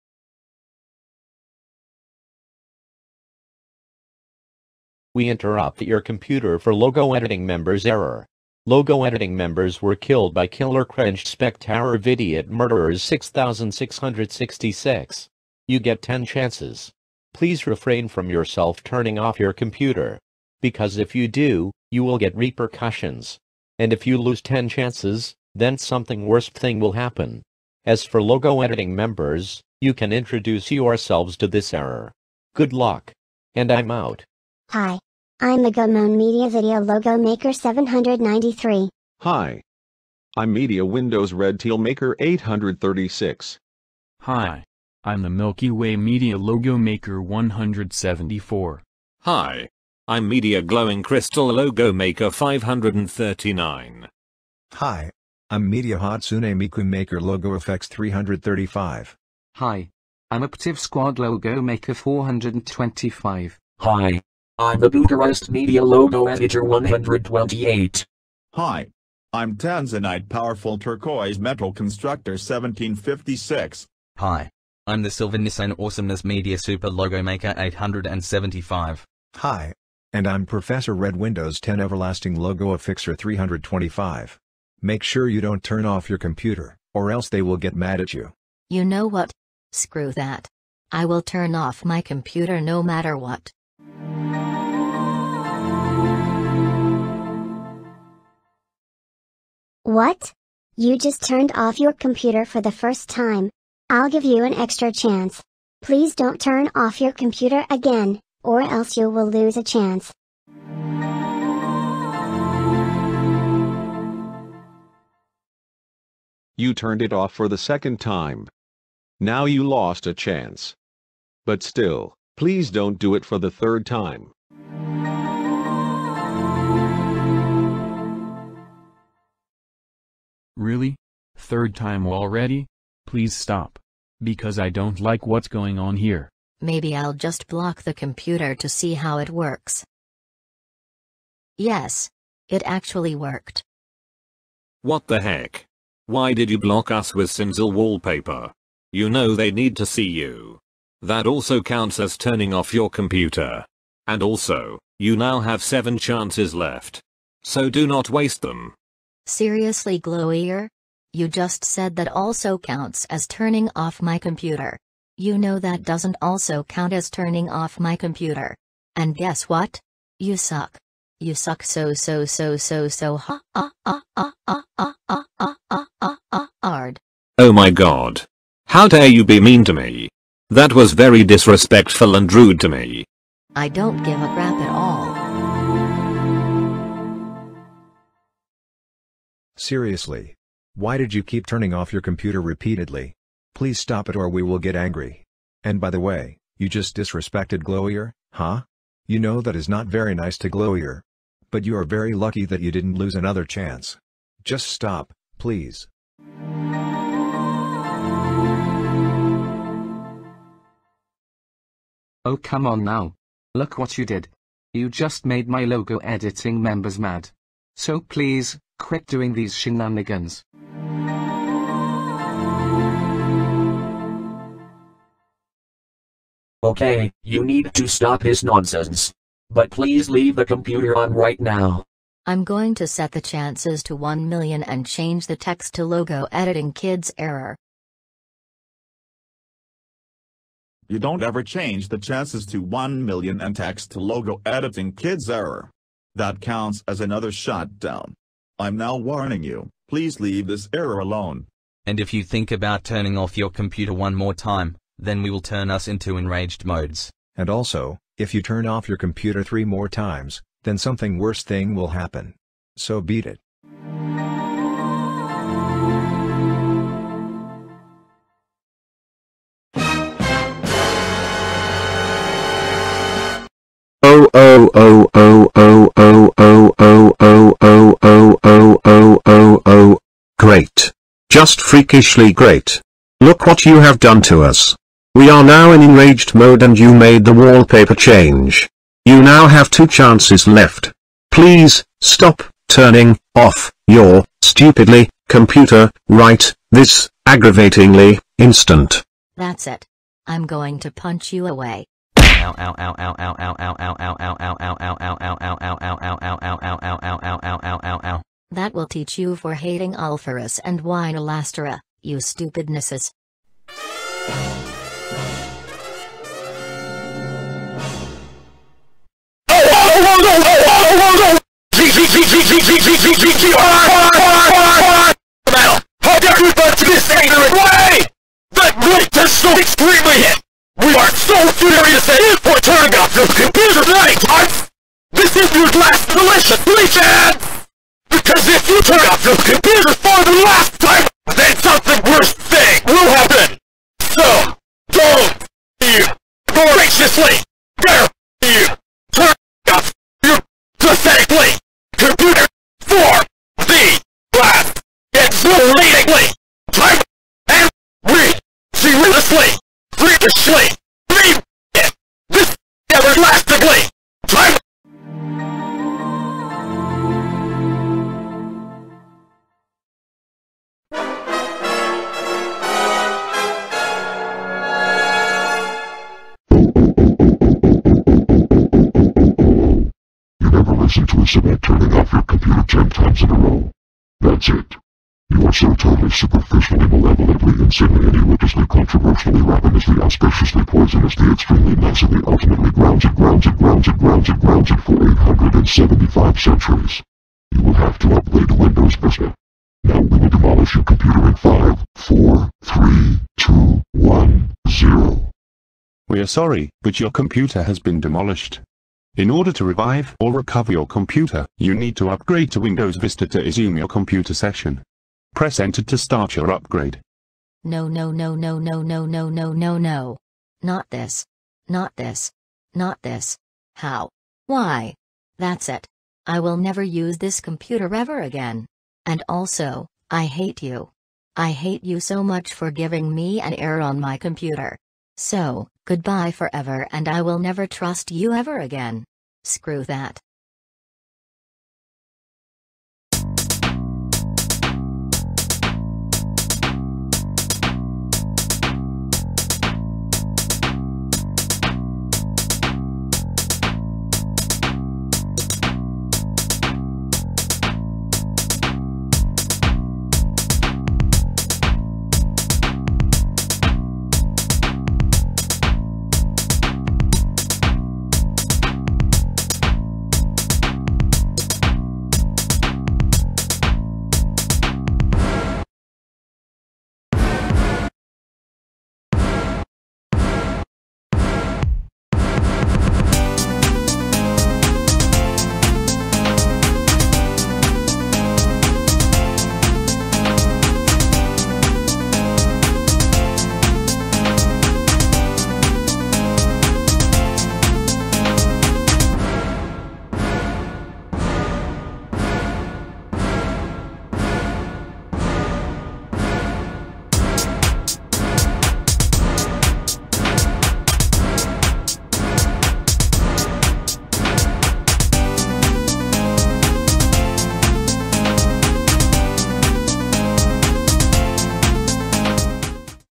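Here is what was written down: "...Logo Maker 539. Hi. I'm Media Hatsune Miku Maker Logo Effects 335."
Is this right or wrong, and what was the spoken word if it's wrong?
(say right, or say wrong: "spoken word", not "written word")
right.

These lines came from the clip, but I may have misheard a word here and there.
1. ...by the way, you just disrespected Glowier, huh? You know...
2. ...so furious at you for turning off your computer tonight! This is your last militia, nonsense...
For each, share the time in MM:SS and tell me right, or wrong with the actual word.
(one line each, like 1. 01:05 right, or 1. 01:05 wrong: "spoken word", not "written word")
1. 03:15 right
2. 05:31 wrong: "please", not "nonsense".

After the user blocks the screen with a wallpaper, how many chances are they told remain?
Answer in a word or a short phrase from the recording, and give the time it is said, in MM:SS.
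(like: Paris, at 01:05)
7, at 02:35.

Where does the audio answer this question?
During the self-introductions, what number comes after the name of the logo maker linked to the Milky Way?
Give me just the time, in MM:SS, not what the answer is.
00:47.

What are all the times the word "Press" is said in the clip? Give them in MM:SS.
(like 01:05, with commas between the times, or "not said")
06:55.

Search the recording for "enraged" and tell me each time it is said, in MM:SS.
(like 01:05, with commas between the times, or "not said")
04:16, 04:45.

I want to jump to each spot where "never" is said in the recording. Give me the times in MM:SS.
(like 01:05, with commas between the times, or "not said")
07:06, 07:17.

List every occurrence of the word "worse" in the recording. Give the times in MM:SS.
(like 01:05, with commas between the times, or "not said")
00:26, 04:21, 05:42.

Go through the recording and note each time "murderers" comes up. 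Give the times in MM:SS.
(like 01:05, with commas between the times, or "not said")
00:12.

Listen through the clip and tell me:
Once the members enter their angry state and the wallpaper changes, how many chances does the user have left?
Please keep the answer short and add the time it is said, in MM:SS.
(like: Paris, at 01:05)
2, at 04:49.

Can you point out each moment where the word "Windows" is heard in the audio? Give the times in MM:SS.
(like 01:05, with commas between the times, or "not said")
00:40, 01:21, 06:38, 06:52.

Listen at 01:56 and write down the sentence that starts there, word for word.
You turned it off for the second time.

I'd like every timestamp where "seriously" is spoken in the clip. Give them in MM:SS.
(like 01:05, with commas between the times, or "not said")
02:39, 03:09, 05:58.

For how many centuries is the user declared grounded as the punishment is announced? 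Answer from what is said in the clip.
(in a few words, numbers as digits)
875.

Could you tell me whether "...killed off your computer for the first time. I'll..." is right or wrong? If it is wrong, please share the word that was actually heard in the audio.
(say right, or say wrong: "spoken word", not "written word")
wrong: "turned", not "killed".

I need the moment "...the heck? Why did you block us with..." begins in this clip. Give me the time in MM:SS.
02:25.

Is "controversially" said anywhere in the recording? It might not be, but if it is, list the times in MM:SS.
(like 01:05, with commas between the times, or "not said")
06:28.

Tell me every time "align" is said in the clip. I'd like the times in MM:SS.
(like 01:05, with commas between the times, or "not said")
not said.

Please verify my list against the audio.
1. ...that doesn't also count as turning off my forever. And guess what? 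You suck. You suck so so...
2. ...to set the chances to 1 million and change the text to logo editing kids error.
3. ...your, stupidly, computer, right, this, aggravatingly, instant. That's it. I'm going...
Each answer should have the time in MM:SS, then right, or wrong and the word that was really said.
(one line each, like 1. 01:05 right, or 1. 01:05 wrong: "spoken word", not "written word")
1. 02:45 wrong: "computer", not "forever"
2. 03:52 right
3. 04:53 right.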